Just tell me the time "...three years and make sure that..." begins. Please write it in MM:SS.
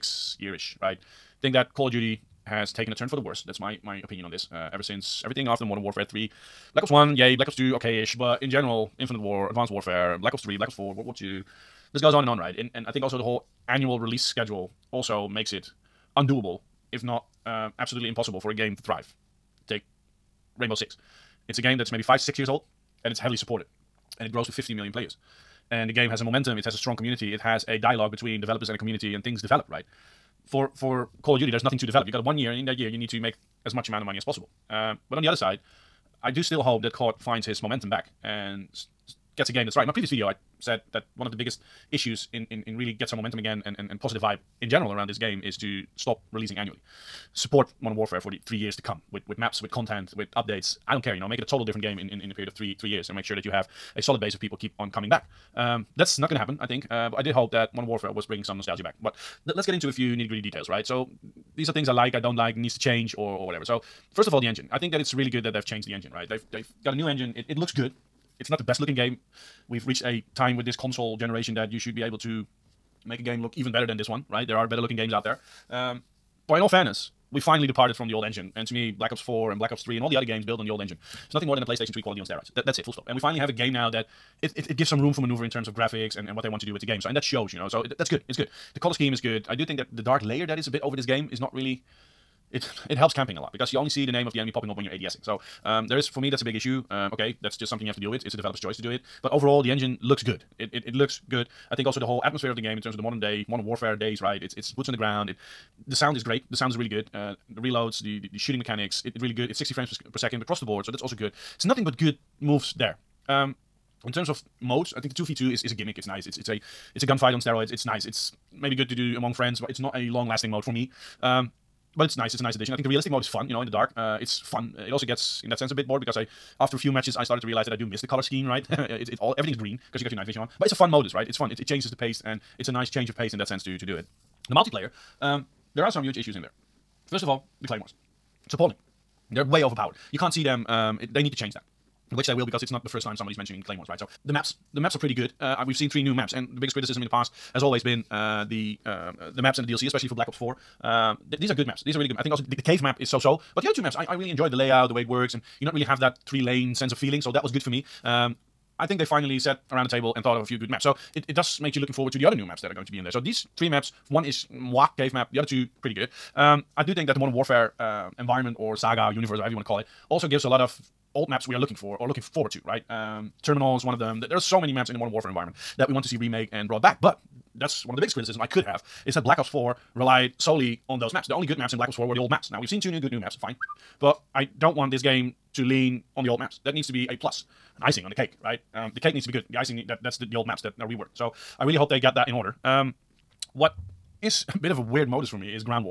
00:52.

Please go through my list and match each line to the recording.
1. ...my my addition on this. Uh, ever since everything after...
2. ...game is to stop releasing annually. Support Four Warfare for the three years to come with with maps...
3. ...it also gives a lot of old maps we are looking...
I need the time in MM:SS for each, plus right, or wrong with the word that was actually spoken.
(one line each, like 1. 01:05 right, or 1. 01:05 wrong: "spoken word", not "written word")
1. 00:03 wrong: "opinion", not "addition"
2. 00:45 wrong: "Modern", not "Four"
3. 02:49 right.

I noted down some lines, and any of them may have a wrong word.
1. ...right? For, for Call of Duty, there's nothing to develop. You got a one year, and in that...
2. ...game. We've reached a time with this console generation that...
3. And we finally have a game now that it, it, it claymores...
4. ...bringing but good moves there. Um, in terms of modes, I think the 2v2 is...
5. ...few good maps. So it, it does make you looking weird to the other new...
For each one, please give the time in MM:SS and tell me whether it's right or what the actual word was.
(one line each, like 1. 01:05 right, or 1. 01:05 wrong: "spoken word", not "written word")
1. 00:29 right
2. 01:08 right
3. 01:23 wrong: "gives", not "claymores"
4. 01:51 wrong: "nothing", not "bringing"
5. 02:40 wrong: "forward", not "weird".